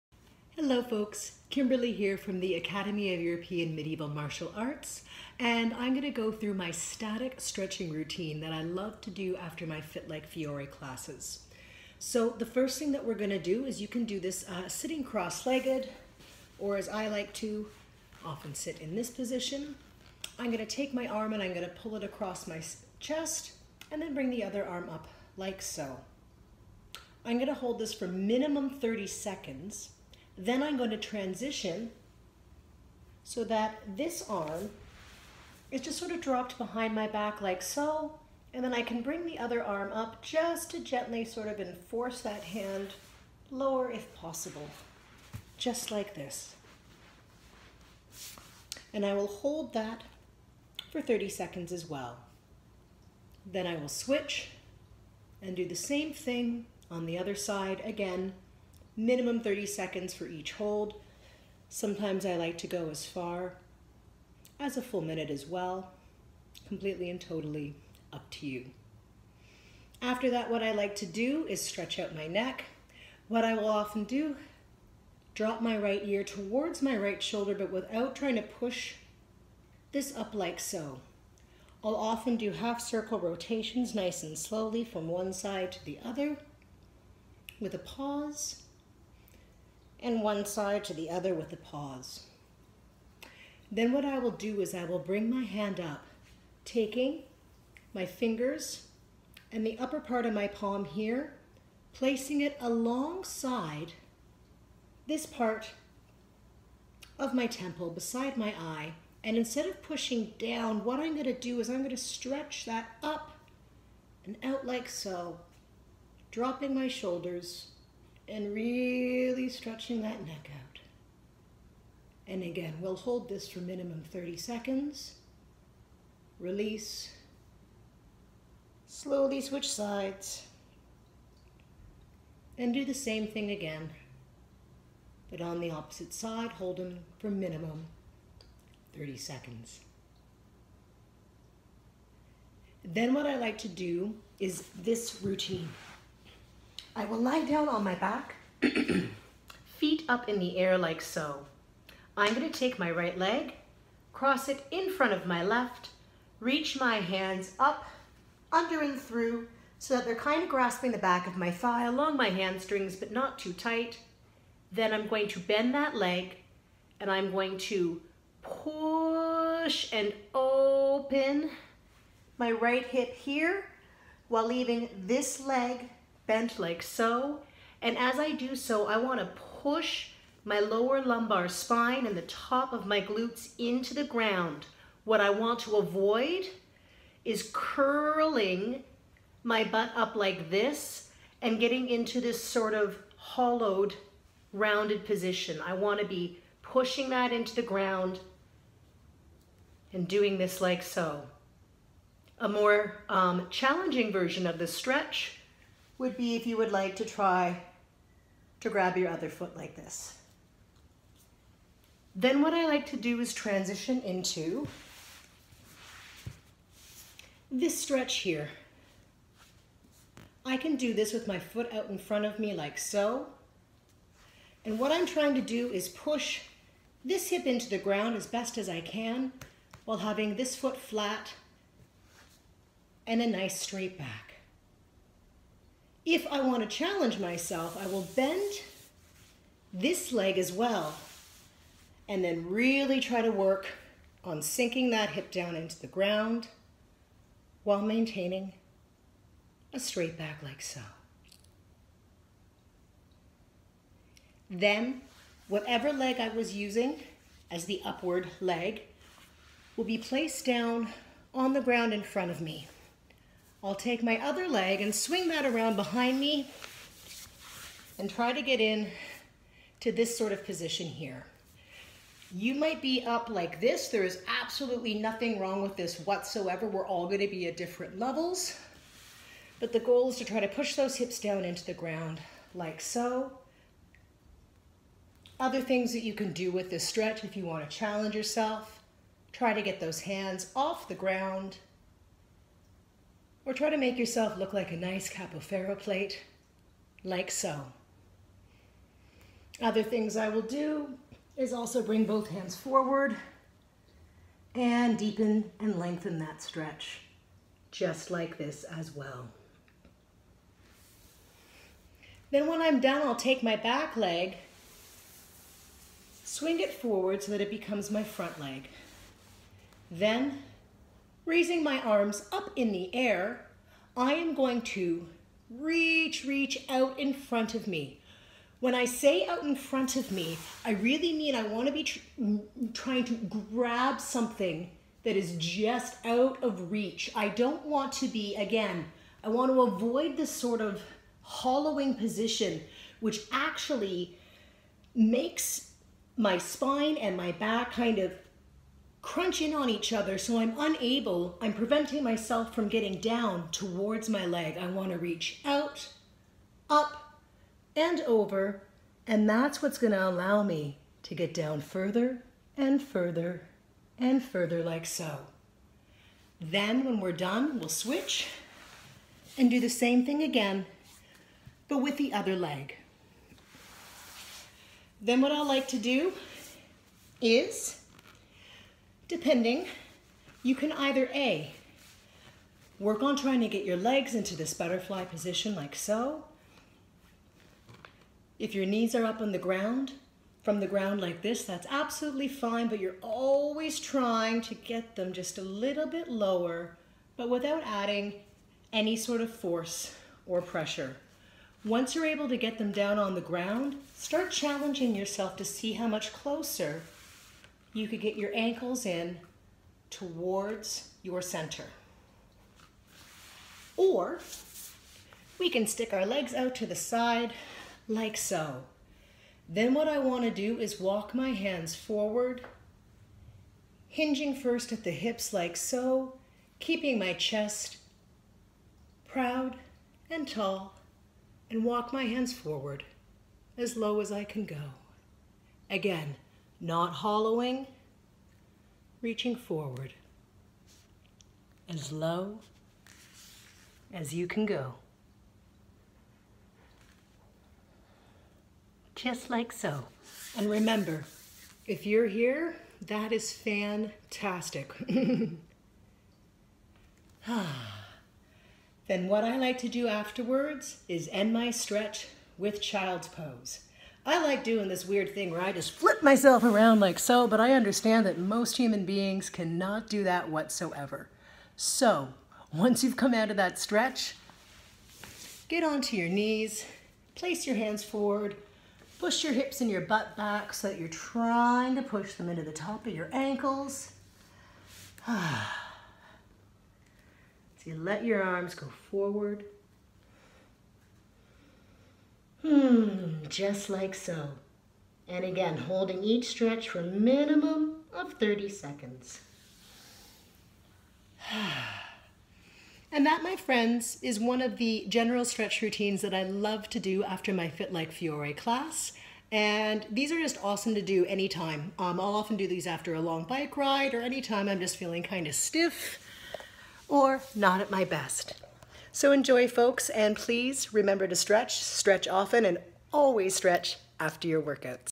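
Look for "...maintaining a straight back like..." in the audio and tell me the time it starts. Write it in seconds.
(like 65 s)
247 s.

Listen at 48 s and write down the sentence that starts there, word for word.
And I will hold that for 30 seconds as well.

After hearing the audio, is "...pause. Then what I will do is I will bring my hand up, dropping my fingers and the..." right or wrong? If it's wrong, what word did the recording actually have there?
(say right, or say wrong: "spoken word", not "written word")
wrong: "taking", not "dropping".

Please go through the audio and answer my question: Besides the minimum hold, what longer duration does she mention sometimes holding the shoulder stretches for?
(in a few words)
a full minute.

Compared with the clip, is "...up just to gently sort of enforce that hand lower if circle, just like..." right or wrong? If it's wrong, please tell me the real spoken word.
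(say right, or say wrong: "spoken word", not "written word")
wrong: "possible", not "circle".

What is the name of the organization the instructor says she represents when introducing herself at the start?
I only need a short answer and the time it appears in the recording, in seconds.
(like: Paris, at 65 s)
Academy of European Medieval Martial Arts, at 2 s.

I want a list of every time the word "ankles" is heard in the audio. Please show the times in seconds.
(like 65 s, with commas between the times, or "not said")
408 s, 483 s.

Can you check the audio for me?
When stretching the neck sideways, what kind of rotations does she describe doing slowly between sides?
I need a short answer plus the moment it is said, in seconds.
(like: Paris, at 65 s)
half circle rotations, at 82 s.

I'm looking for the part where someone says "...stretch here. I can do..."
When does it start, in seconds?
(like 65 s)
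217 s.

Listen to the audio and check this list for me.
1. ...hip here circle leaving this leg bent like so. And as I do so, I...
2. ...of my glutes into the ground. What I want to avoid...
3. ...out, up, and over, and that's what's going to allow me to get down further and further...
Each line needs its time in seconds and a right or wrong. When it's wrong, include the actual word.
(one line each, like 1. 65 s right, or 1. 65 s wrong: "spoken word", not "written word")
1. 172 s wrong: "while", not "circle"
2. 182 s right
3. 355 s right.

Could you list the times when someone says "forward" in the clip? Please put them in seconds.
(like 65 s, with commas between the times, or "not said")
302 s, 316 s, 421 s, 432 s, 439 s, 477 s, 488 s.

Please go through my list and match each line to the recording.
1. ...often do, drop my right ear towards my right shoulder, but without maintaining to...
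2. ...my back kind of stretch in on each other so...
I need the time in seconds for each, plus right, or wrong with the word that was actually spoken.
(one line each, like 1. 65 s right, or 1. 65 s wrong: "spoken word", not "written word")
1. 73 s wrong: "trying", not "maintaining"
2. 347 s wrong: "crunch", not "stretch".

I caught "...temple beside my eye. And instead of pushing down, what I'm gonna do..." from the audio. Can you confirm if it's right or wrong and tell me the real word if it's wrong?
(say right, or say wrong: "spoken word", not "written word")
right.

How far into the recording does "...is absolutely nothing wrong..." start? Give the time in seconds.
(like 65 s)
274 s.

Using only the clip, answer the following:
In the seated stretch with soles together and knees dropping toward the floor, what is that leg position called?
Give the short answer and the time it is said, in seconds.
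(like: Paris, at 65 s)
butterfly position, at 384 s.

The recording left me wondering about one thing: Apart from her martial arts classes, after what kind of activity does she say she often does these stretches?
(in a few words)
a long bike ride.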